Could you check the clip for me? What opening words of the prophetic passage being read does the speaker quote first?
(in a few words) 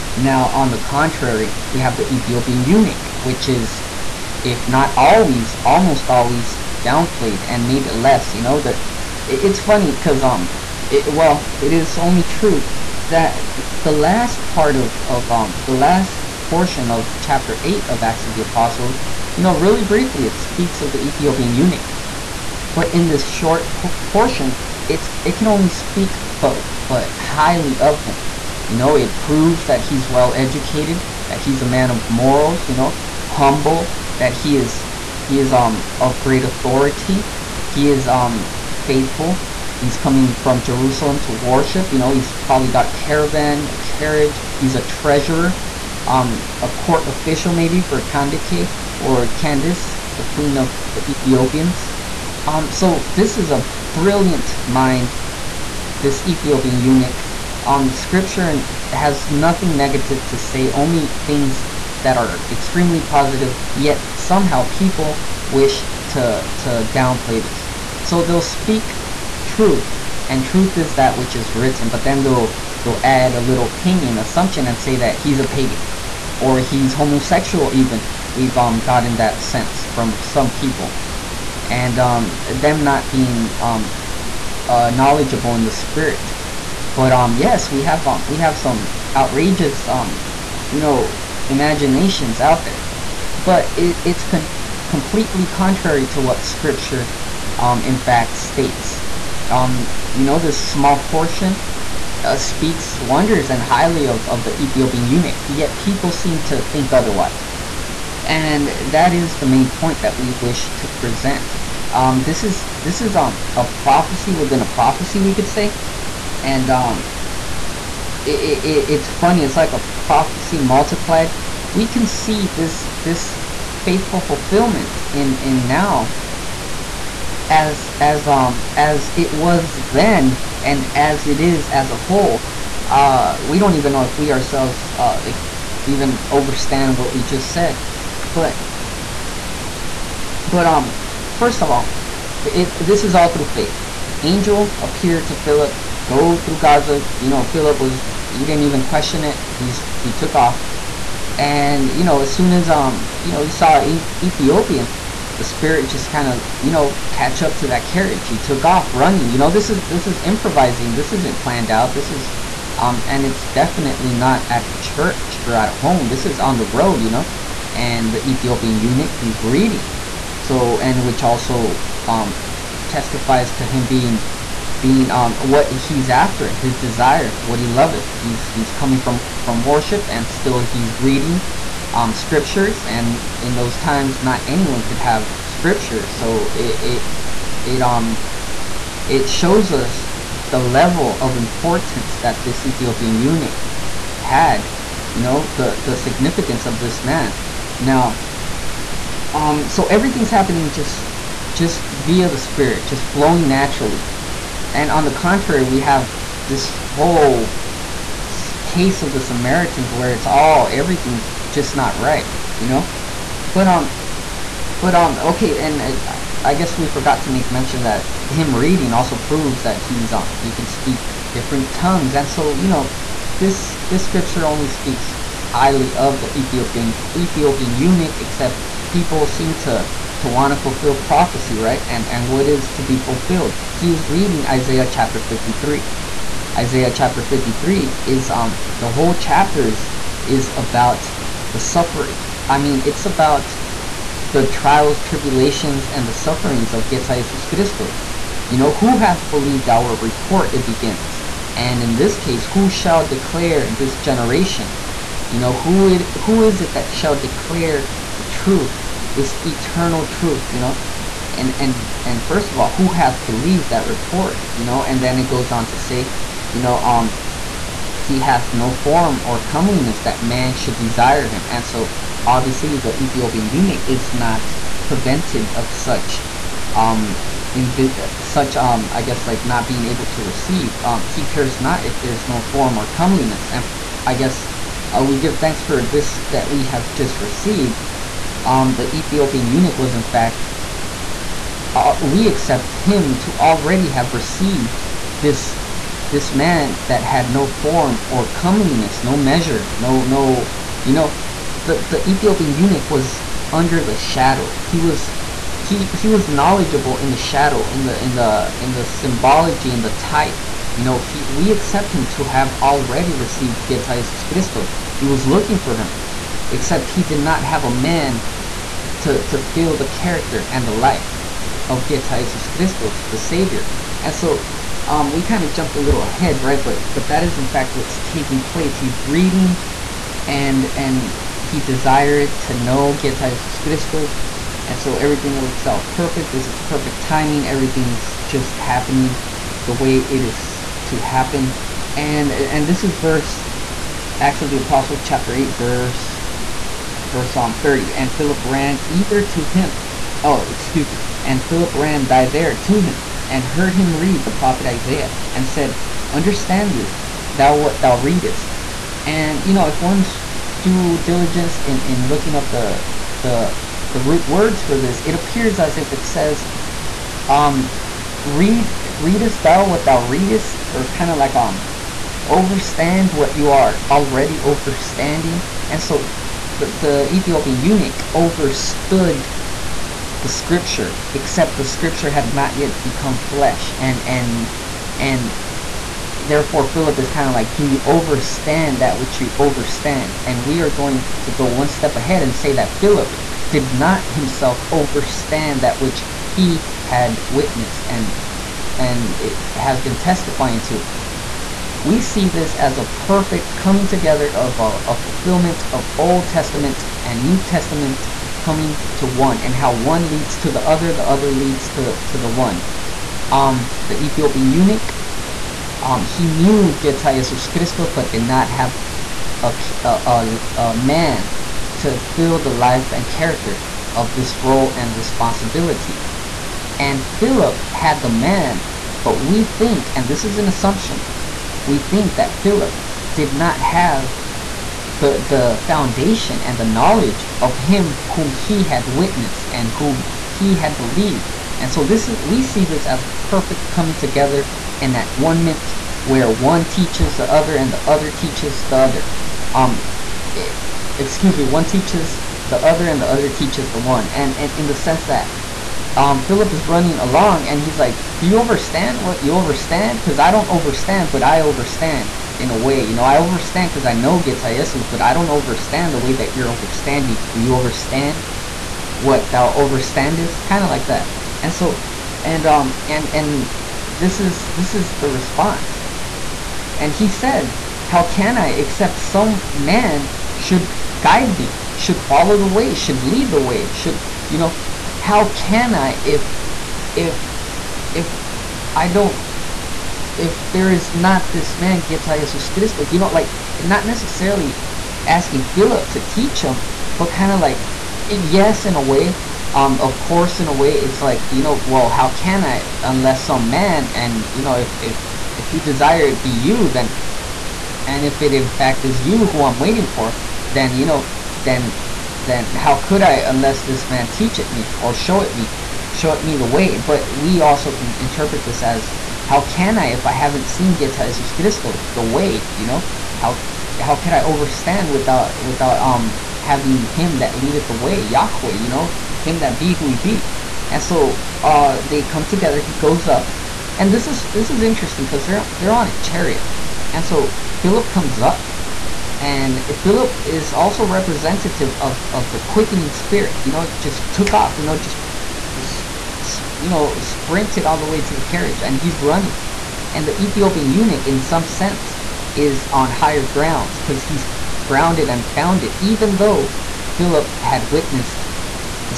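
Who hath believed our report.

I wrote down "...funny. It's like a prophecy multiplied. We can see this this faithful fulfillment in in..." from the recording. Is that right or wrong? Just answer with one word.
right.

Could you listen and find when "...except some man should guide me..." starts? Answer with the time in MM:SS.
07:58.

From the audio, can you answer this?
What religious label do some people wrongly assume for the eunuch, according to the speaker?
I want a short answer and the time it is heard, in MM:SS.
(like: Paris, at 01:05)
Pagan, at 01:15.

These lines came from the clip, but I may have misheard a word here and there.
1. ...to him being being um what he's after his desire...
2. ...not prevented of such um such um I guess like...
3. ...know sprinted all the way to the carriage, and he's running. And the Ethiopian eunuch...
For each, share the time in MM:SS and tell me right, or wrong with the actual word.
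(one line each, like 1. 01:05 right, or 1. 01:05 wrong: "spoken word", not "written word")
1. 02:53 right
2. 04:34 right
3. 09:06 right.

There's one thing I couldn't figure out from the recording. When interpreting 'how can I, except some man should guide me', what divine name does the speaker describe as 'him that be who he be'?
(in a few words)
Yahweh.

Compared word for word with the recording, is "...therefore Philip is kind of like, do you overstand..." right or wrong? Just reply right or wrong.
right.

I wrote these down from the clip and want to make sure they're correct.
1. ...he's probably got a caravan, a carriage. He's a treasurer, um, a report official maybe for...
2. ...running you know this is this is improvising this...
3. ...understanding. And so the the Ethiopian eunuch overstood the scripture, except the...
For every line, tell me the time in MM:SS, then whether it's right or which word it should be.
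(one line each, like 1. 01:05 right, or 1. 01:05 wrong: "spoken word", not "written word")
1. 00:42 wrong: "court", not "report"
2. 02:38 right
3. 06:14 wrong: "overstanding", not "understanding".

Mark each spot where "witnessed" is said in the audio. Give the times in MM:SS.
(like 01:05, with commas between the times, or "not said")
06:37, 07:18, 09:17.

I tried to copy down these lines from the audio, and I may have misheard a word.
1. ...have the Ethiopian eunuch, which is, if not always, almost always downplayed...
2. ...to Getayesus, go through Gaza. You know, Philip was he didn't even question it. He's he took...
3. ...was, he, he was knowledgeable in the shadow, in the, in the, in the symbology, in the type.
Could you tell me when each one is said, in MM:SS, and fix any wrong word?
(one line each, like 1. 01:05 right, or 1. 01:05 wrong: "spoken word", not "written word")
1. 00:01 right
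2. 02:25 wrong: "Philip", not "Getayesus"
3. 05:04 right.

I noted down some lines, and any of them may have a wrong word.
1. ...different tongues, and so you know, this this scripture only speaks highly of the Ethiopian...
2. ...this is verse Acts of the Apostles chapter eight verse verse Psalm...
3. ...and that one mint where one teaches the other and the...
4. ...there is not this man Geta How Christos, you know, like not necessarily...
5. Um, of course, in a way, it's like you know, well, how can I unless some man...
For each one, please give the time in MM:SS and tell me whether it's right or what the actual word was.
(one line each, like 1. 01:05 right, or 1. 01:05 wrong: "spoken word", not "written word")
1. 03:41 right
2. 05:42 right
3. 07:24 right
4. 08:10 wrong: "Jesus", not "How"
5. 08:19 right.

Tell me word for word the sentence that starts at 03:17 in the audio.
Now, um, so everything's happening just just via the spirit, just flowing naturally.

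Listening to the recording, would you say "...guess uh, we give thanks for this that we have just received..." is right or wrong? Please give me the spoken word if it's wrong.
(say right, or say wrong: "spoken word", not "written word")
right.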